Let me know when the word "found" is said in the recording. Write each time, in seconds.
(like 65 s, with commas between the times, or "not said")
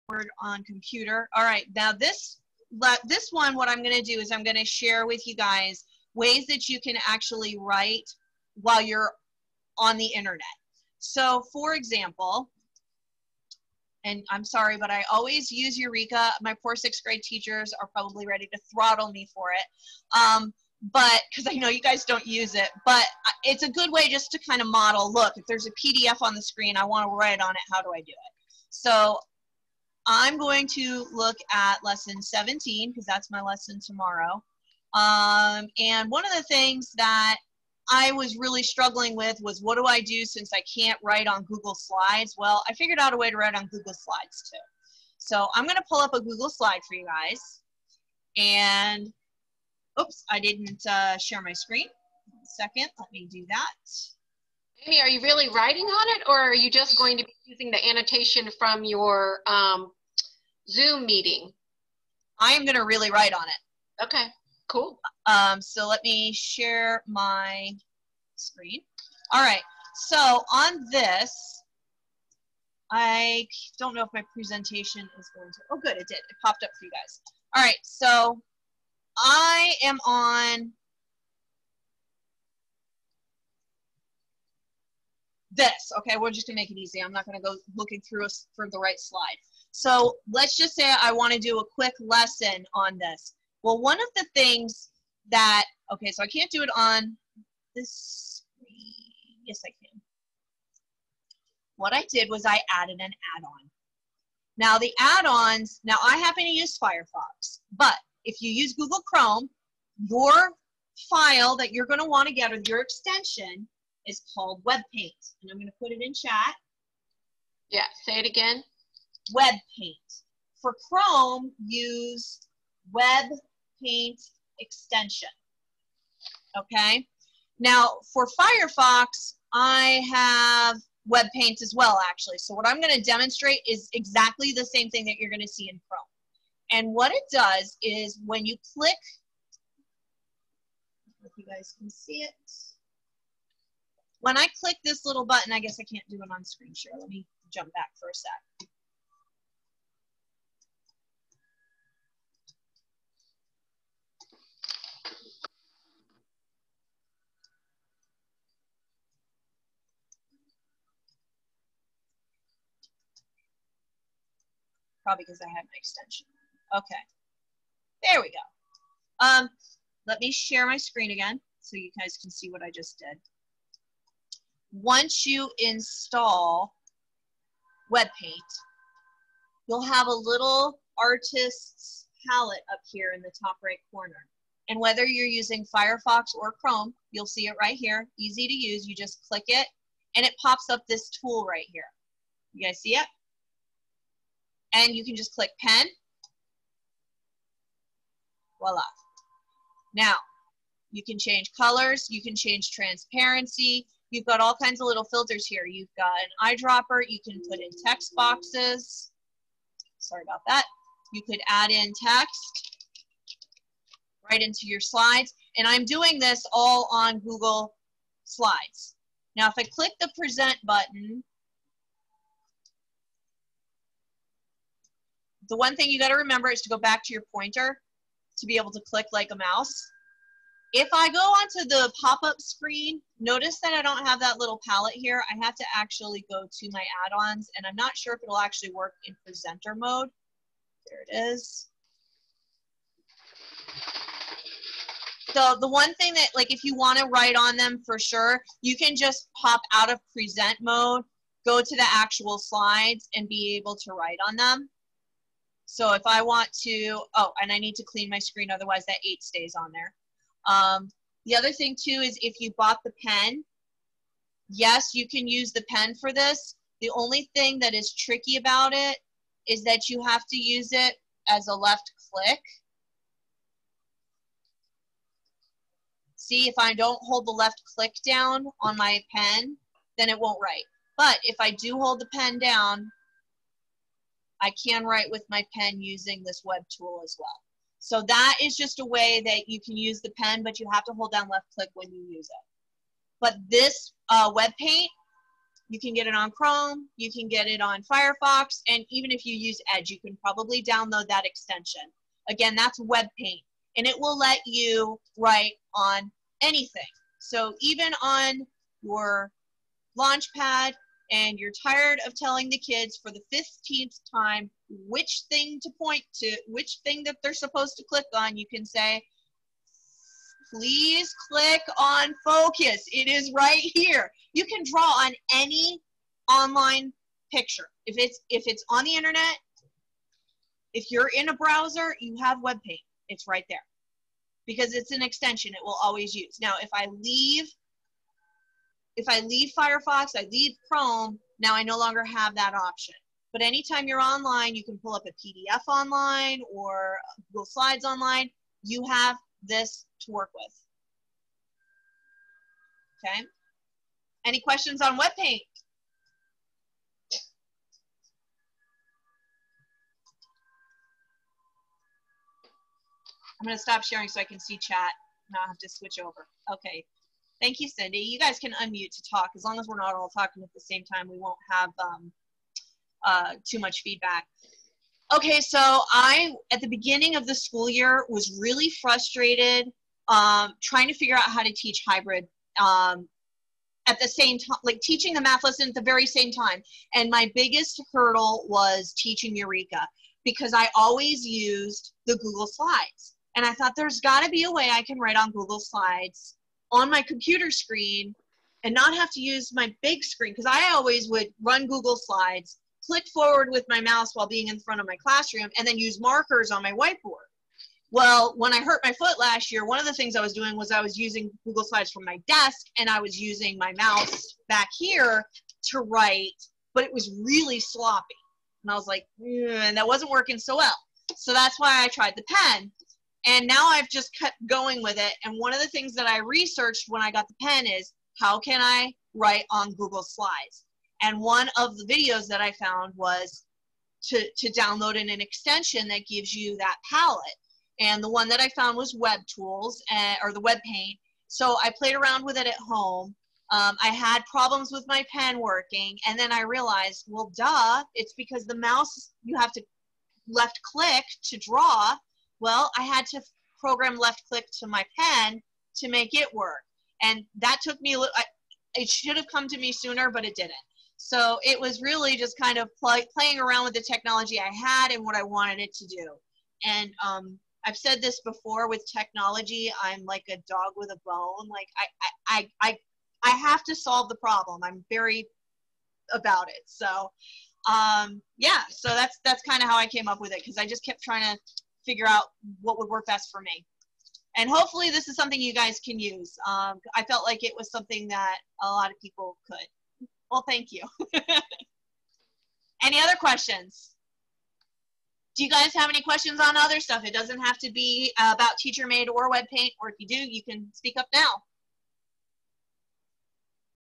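432 s, 438 s.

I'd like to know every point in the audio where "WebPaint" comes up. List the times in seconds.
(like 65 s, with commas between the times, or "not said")
114 s, 177 s, 354 s.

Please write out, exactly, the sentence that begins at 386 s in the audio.
And my biggest hurdle was teaching Eureka because I always used the Google Slides.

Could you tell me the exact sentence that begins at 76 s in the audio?
It popped up for you guys.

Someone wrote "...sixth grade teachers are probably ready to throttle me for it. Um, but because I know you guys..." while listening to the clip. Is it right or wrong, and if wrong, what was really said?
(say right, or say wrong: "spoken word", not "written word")
right.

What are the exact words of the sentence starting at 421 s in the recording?
So that's why I tried the pen.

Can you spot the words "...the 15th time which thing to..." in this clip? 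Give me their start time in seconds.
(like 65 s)
313 s.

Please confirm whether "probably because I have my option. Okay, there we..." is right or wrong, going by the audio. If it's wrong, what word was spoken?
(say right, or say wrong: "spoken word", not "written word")
wrong: "extension", not "option".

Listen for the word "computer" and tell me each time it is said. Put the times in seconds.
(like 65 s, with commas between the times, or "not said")
0 s, 397 s.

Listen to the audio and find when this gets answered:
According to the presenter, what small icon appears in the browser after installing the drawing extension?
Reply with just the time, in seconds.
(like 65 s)
180 s.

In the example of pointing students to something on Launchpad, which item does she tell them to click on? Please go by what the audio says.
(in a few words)
focus.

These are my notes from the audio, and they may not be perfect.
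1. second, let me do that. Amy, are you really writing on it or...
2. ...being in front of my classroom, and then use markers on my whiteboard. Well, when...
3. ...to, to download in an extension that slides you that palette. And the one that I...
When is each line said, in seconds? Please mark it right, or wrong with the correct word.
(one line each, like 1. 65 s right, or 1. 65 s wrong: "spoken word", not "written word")
1. 52 s right
2. 404 s right
3. 434 s wrong: "gives", not "slides".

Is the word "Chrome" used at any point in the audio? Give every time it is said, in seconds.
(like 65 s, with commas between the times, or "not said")
109 s, 120 s, 135 s, 186 s, 296 s, 340 s.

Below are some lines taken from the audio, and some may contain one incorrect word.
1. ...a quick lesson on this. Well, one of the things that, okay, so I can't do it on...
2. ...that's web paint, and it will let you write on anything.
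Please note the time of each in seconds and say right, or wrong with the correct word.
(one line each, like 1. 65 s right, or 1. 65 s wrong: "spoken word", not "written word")
1. 91 s right
2. 302 s right.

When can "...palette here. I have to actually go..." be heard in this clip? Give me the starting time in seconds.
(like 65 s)
234 s.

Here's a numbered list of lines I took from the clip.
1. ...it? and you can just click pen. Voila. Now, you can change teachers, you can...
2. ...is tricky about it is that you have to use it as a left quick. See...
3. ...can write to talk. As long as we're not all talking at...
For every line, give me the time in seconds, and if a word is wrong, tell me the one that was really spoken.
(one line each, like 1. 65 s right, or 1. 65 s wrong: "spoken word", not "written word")
1. 192 s wrong: "colors", not "teachers"
2. 267 s wrong: "click", not "quick"
3. 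368 s wrong: "unmute", not "write".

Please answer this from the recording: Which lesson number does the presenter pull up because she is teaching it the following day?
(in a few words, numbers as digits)
17.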